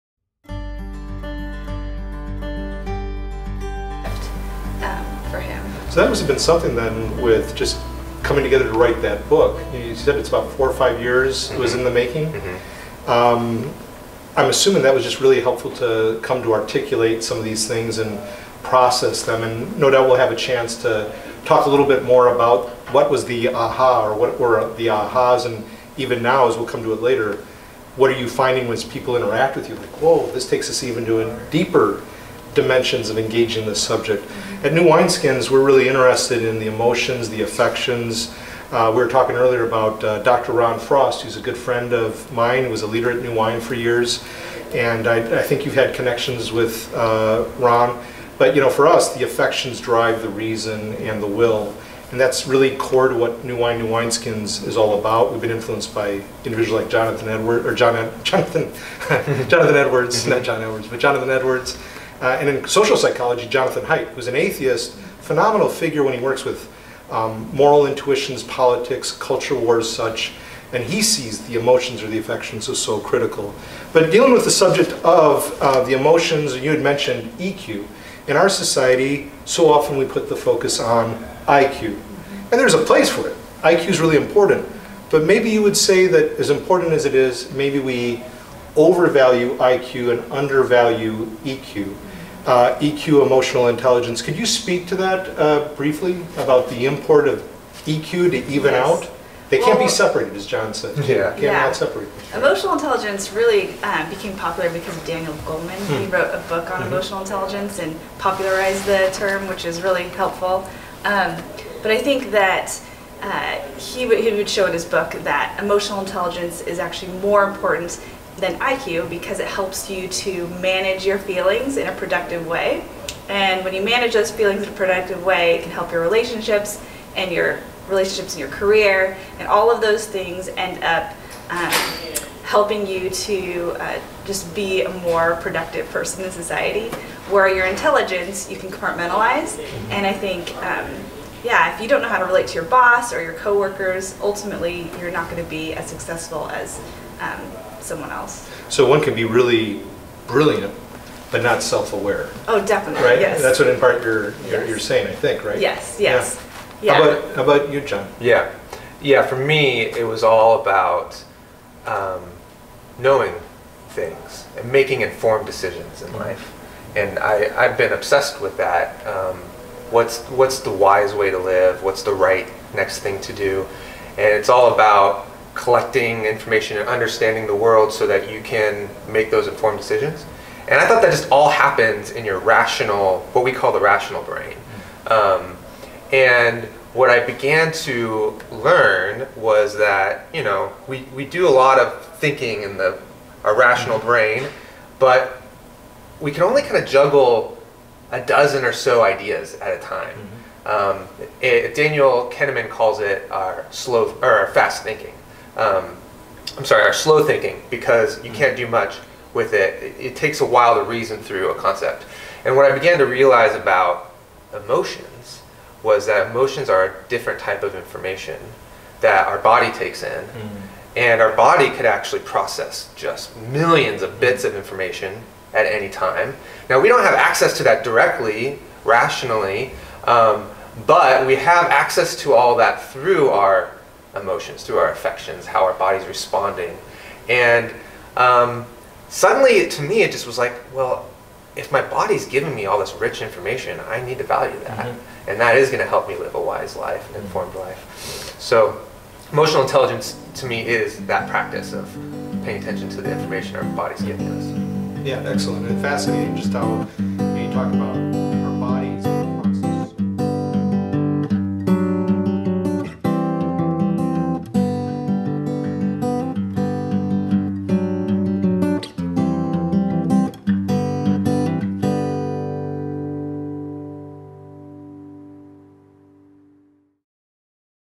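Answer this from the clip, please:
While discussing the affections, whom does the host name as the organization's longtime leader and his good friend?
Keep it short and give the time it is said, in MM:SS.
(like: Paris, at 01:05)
Ron Frost, at 00:40.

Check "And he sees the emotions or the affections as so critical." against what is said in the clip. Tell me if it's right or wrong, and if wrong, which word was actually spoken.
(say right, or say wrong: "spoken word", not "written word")
right.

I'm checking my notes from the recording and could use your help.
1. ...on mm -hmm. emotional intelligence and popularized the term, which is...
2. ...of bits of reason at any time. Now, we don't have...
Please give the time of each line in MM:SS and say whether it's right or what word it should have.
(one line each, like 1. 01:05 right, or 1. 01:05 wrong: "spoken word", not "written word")
1. 01:46 right
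2. 03:44 wrong: "information", not "reason".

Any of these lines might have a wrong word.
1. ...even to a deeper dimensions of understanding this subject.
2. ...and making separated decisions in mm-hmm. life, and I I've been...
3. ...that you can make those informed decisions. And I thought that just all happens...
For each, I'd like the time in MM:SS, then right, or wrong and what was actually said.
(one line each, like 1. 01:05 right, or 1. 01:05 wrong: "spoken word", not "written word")
1. 00:30 wrong: "engaging", not "understanding"
2. 02:44 wrong: "informed", not "separated"
3. 02:58 right.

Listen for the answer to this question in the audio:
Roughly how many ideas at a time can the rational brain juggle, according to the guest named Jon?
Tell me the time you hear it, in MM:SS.
03:18.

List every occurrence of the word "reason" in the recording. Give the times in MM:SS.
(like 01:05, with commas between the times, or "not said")
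00:50, 03:30.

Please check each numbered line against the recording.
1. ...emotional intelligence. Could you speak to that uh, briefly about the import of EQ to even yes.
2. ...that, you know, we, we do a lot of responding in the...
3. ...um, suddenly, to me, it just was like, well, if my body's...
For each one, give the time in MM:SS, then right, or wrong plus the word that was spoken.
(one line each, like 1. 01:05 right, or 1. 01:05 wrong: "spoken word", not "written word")
1. 01:33 right
2. 03:09 wrong: "thinking", not "responding"
3. 03:58 right.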